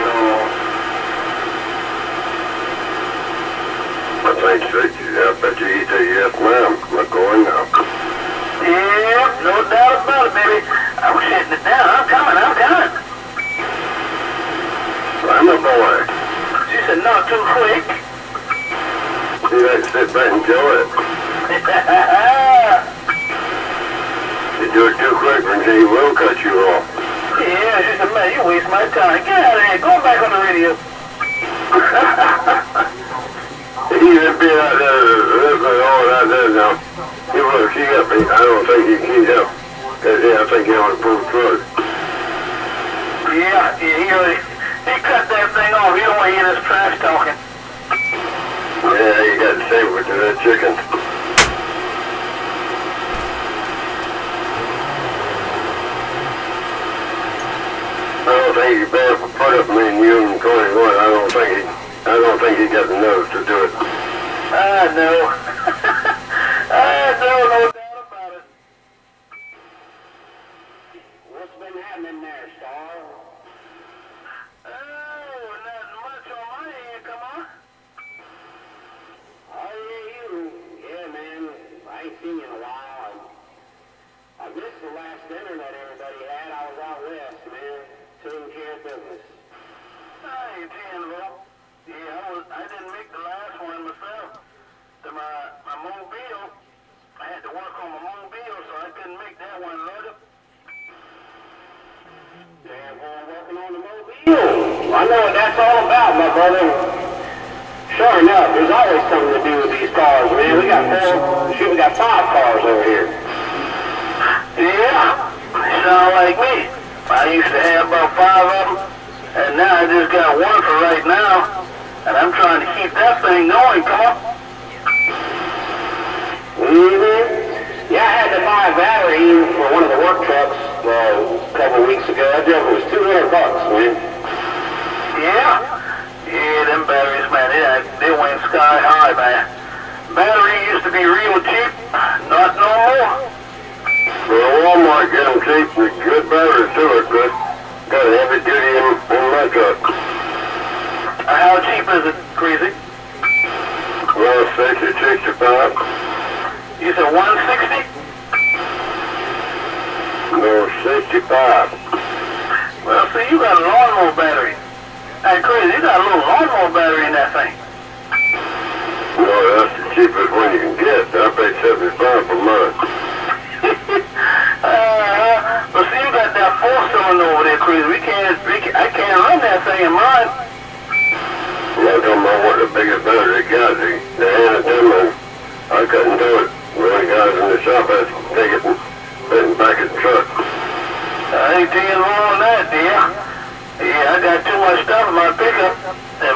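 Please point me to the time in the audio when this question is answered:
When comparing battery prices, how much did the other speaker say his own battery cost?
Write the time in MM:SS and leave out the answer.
02:51.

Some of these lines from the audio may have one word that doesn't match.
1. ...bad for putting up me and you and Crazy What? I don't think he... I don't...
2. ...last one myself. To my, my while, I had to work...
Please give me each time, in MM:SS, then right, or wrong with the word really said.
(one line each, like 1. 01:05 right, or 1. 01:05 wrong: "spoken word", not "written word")
1. 00:58 wrong: "Cody", not "Crazy"
2. 01:33 wrong: "mobile", not "while".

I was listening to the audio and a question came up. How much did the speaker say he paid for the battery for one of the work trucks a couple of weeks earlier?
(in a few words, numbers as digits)
$200.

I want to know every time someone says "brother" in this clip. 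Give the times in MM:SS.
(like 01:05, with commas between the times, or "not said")
01:46.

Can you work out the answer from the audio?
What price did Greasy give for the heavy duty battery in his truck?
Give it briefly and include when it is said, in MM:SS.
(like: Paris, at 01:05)
$65, at 02:40.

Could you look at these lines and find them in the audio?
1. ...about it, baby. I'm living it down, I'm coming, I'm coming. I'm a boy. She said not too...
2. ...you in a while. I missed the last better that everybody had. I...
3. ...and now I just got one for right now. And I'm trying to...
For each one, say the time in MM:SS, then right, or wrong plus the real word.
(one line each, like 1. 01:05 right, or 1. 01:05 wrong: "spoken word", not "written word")
1. 00:09 wrong: "hitting", not "living"
2. 01:22 wrong: "dinner", not "better"
3. 01:59 right.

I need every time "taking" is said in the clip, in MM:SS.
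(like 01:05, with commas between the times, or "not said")
01:28, 03:11.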